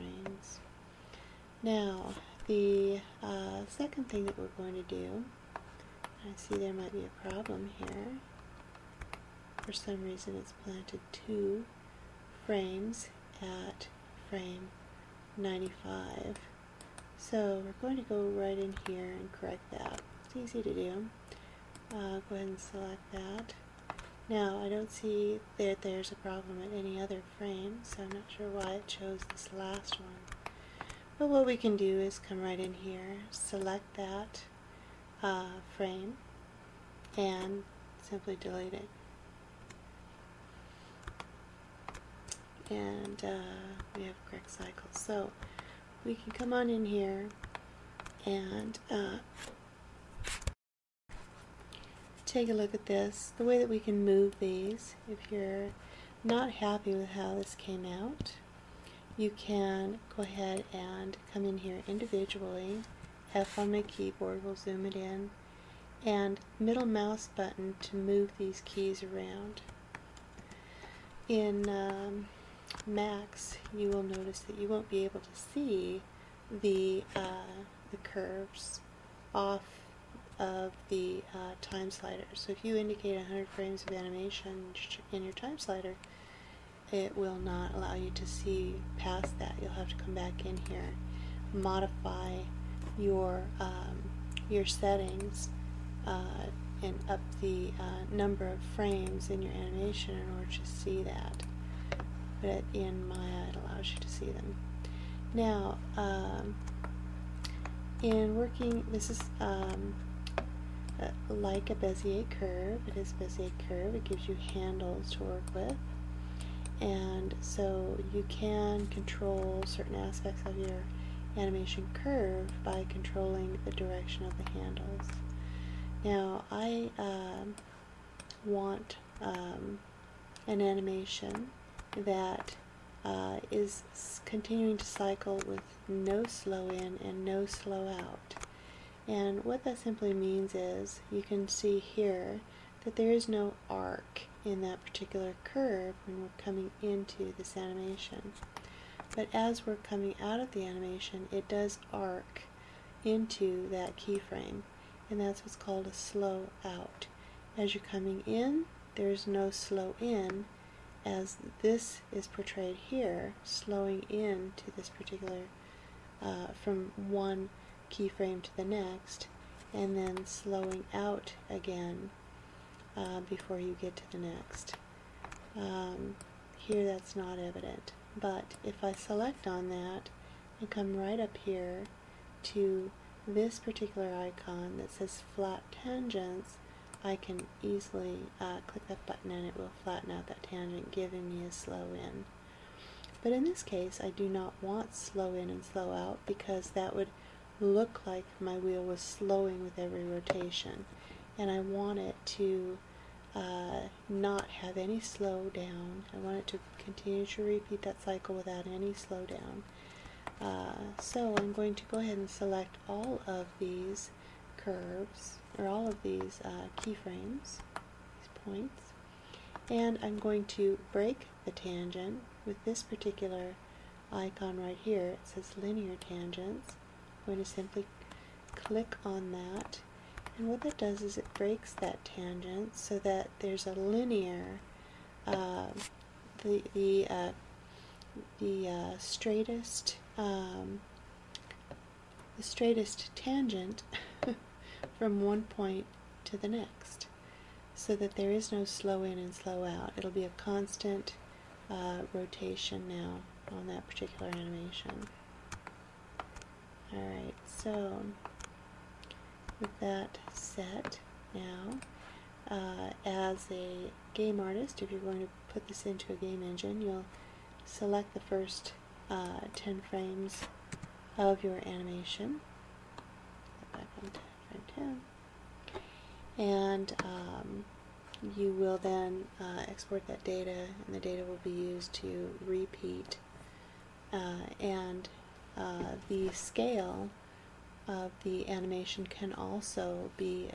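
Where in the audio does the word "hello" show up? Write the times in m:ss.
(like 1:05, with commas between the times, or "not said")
not said.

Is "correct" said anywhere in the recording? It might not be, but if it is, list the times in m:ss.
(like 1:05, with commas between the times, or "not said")
0:19, 0:44.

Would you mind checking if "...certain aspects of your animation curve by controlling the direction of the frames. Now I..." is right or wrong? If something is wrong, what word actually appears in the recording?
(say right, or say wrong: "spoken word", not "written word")
wrong: "handles", not "frames".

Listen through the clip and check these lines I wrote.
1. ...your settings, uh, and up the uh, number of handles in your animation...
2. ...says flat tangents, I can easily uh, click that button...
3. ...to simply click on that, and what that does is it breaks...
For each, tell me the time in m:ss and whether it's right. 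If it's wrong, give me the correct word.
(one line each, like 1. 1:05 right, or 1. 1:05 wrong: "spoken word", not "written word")
1. 1:34 wrong: "frames", not "handles"
2. 3:04 right
3. 3:47 right.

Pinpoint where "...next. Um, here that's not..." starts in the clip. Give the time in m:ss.
2:54.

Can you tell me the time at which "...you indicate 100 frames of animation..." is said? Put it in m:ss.
1:22.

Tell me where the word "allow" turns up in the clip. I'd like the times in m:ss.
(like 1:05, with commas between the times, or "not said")
1:27, 1:43.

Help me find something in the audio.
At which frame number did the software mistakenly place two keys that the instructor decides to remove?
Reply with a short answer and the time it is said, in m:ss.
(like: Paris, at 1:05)
95, at 0:14.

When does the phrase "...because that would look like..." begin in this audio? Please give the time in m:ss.
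3:16.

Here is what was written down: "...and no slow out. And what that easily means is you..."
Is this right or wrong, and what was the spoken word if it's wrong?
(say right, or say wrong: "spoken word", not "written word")
wrong: "simply", not "easily".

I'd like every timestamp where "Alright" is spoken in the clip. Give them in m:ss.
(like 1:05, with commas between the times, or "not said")
4:16.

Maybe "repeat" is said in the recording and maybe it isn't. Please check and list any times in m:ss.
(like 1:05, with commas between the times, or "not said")
3:27, 4:42.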